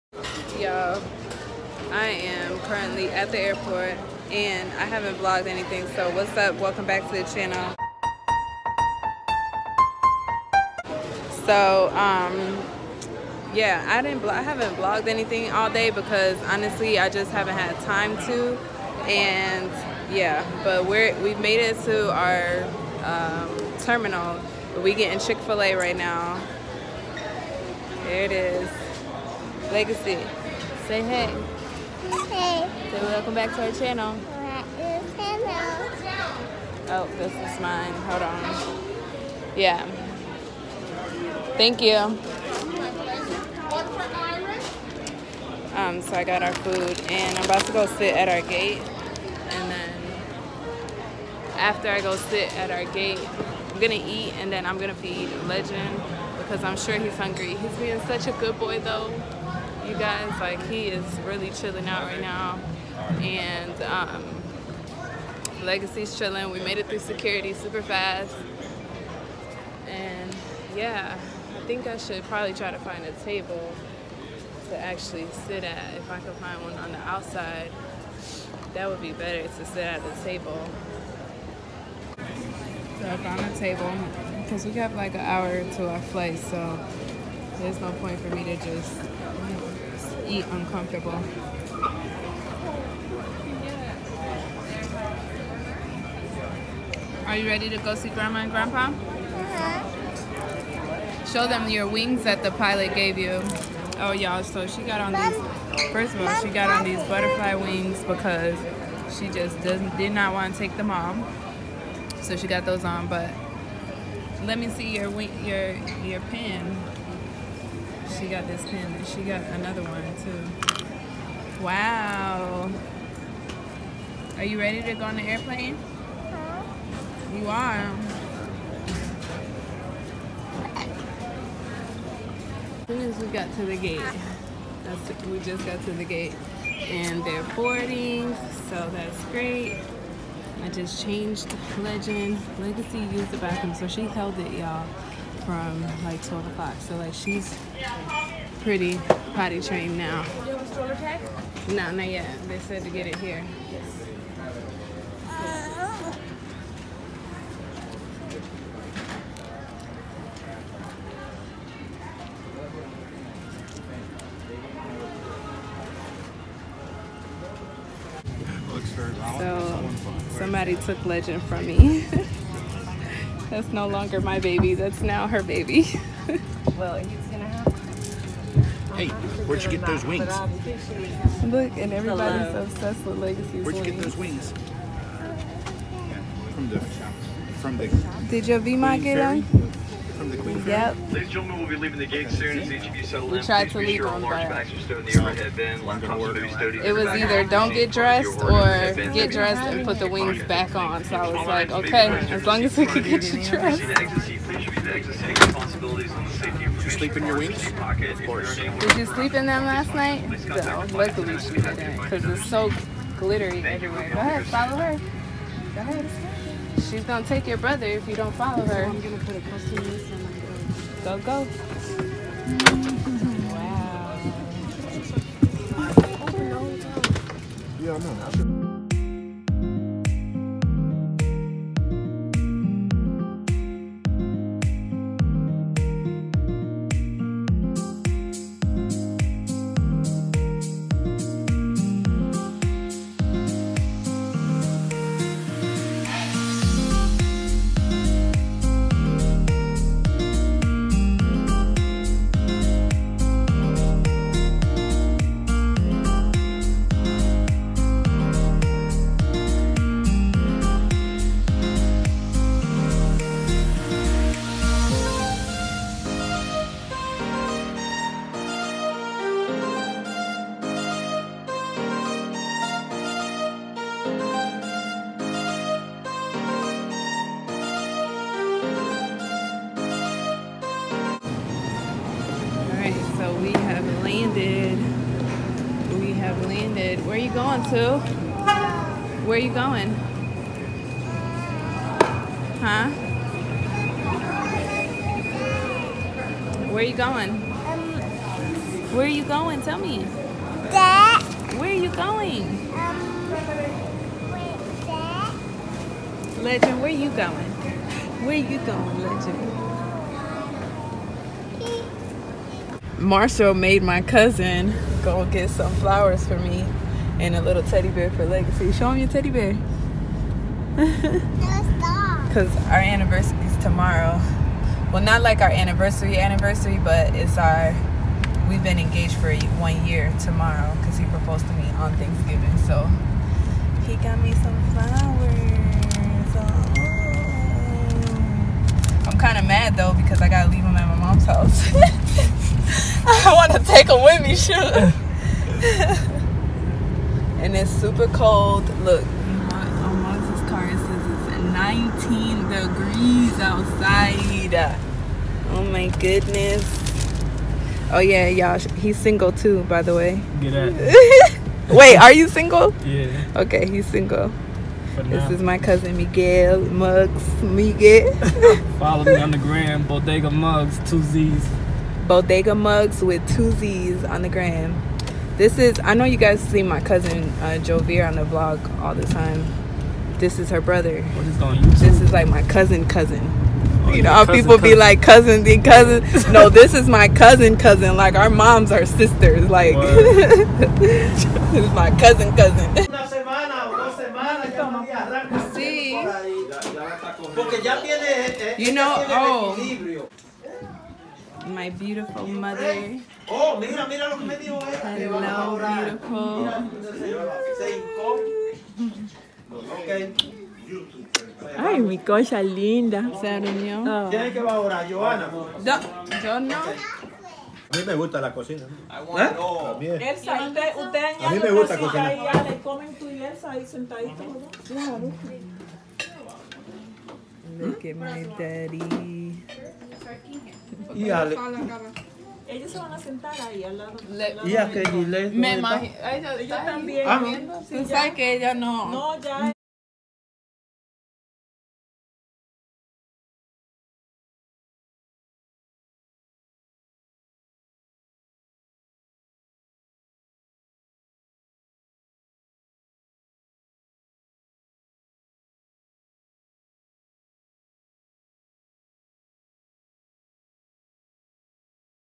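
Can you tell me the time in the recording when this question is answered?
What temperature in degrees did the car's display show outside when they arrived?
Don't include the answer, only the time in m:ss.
5:51.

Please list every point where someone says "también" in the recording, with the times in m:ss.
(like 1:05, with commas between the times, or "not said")
7:16.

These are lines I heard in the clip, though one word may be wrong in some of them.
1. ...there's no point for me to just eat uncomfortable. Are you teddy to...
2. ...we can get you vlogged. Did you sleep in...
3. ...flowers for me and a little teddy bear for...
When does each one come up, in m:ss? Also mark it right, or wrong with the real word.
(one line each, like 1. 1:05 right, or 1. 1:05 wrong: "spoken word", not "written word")
1. 1:27 wrong: "ready", not "teddy"
2. 3:22 wrong: "dressed", not "vlogged"
3. 5:15 right.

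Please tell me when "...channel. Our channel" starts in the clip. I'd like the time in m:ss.
0:33.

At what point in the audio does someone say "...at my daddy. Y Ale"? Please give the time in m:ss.
7:07.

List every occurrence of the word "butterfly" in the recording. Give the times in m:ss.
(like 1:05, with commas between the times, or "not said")
1:47.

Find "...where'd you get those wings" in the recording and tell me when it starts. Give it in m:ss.
2:59.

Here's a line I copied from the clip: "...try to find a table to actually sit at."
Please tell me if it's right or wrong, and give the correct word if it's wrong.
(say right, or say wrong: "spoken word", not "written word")
right.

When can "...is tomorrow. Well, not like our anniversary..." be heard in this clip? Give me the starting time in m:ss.
5:23.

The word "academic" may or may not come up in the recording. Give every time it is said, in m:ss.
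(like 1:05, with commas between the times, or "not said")
not said.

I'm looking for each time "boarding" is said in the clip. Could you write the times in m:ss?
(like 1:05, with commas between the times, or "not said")
2:17.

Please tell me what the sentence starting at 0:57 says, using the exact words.
He's being such a good boy though you guys.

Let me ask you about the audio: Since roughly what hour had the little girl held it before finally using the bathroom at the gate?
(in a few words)
12 o'clock.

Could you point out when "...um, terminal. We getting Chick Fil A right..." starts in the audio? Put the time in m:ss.
0:23.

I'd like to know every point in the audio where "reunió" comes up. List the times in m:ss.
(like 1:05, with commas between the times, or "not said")
6:53.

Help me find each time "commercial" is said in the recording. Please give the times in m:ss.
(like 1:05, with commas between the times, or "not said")
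not said.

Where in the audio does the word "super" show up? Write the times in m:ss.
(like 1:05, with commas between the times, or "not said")
1:07, 5:47.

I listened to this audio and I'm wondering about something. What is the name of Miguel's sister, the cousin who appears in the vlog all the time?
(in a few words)
Jovier.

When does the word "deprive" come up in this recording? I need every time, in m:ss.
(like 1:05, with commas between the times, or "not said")
not said.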